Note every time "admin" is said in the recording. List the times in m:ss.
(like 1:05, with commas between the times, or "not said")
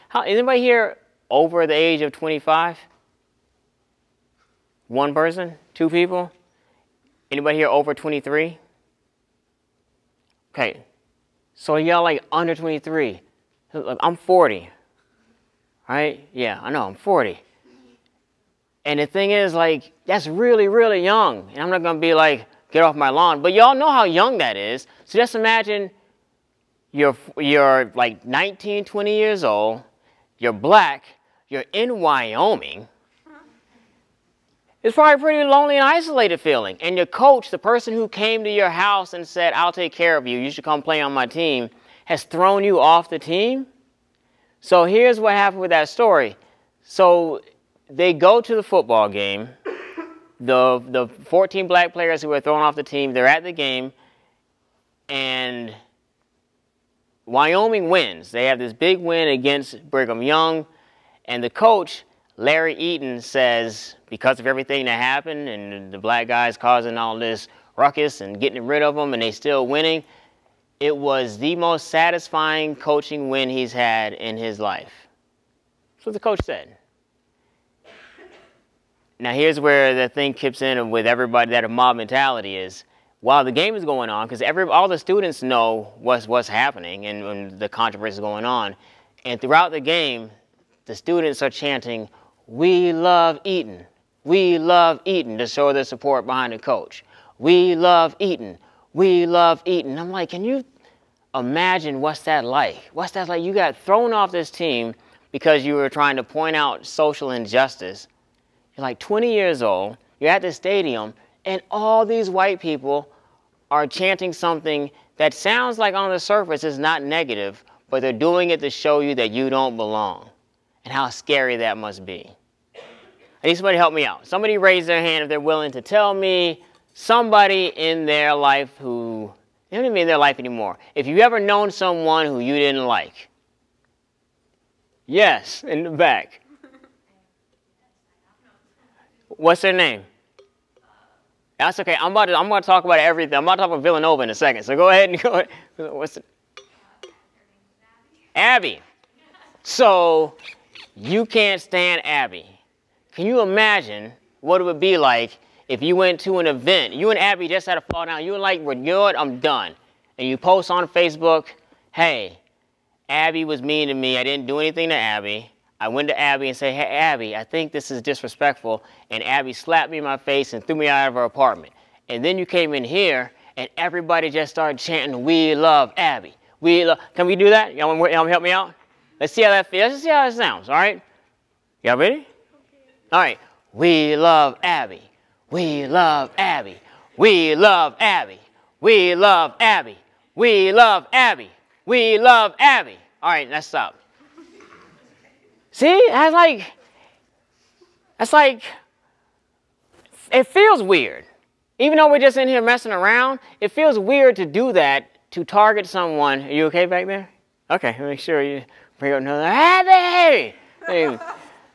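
not said.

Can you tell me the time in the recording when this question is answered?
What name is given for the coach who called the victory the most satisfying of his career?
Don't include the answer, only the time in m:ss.
1:02.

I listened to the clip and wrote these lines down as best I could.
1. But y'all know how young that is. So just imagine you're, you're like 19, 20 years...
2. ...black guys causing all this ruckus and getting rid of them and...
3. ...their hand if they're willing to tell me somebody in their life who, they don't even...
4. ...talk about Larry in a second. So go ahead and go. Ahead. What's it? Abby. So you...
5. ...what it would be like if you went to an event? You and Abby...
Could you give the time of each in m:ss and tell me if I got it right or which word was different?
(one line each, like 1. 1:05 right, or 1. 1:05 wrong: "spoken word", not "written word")
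1. 0:23 right
2. 1:05 right
3. 2:04 right
4. 2:23 wrong: "Villanova", not "Larry"
5. 2:34 right.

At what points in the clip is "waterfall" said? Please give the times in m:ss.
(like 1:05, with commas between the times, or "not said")
not said.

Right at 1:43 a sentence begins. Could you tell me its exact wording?
You got thrown off this team because you were trying to point out social injustice.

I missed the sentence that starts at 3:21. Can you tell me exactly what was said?
Even though we're just in here messing around, it feels weird to do that to target someone.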